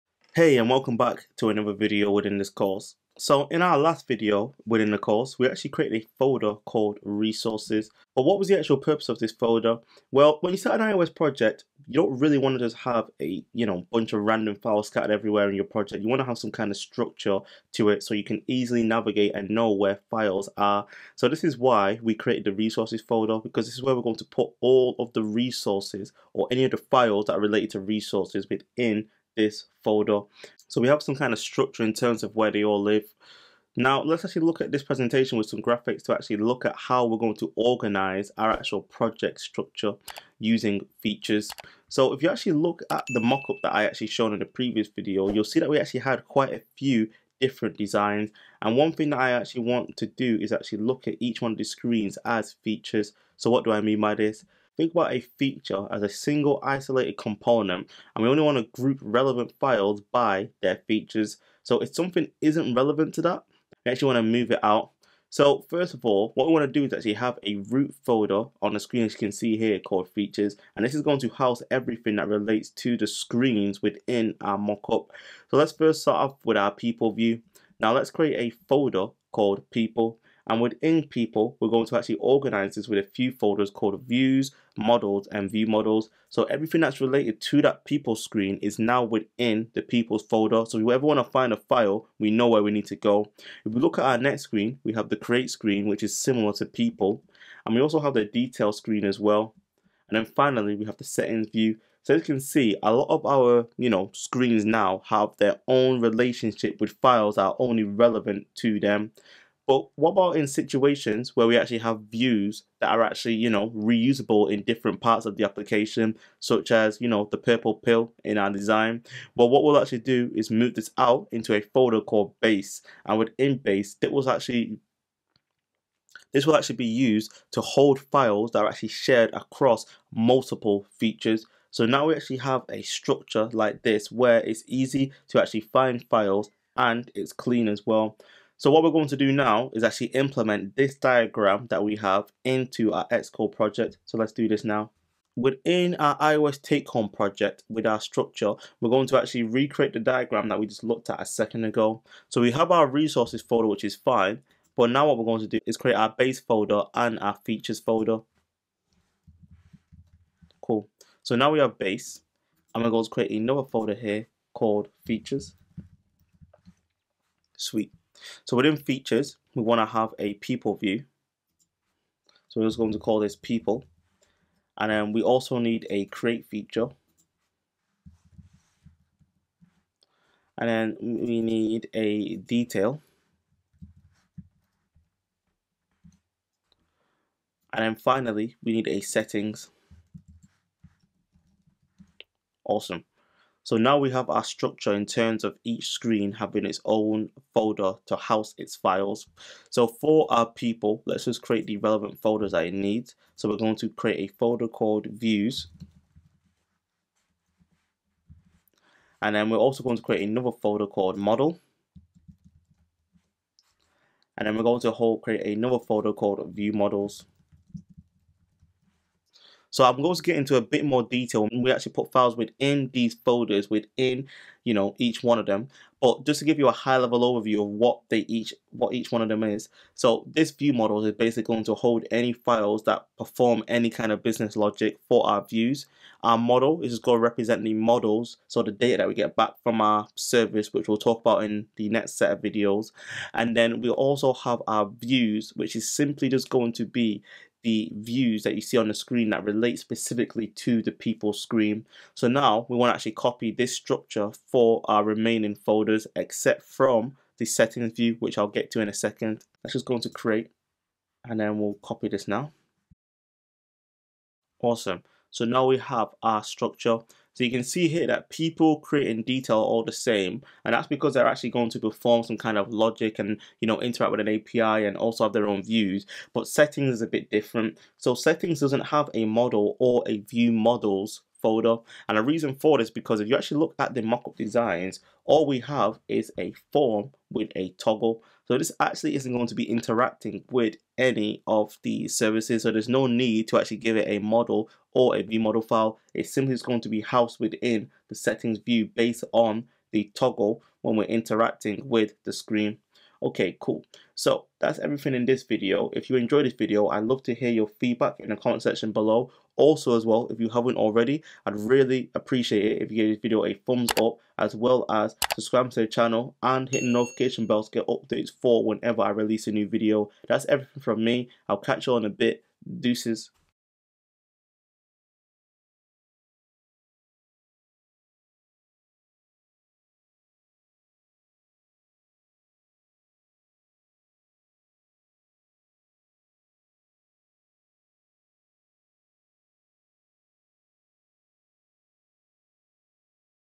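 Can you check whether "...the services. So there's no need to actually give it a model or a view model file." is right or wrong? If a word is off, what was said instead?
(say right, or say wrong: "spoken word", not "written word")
right.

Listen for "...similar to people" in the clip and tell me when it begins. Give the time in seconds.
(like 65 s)
96 s.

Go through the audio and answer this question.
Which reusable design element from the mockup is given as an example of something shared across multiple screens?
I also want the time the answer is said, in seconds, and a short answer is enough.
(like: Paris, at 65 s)
purple pill, at 117 s.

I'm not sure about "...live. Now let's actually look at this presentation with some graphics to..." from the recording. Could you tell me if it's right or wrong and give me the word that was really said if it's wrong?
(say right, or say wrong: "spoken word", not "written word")
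right.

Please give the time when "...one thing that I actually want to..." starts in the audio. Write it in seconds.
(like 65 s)
48 s.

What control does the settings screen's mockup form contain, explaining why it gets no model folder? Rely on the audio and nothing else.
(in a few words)
a toggle.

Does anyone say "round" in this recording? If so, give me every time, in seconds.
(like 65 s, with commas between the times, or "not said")
not said.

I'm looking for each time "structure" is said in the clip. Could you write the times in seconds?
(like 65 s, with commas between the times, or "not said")
16 s, 31 s, 39 s, 132 s, 147 s, 194 s, 253 s, 266 s.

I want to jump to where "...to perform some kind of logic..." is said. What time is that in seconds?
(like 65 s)
271 s.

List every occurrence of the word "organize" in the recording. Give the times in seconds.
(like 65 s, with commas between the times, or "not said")
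37 s, 82 s.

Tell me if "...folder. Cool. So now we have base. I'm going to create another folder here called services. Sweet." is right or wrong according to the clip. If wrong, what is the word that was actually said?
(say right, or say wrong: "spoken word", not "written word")
wrong: "features", not "services".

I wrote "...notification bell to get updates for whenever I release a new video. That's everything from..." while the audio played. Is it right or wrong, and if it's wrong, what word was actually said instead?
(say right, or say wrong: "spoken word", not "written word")
right.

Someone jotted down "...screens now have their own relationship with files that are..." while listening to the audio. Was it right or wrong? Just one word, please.
right.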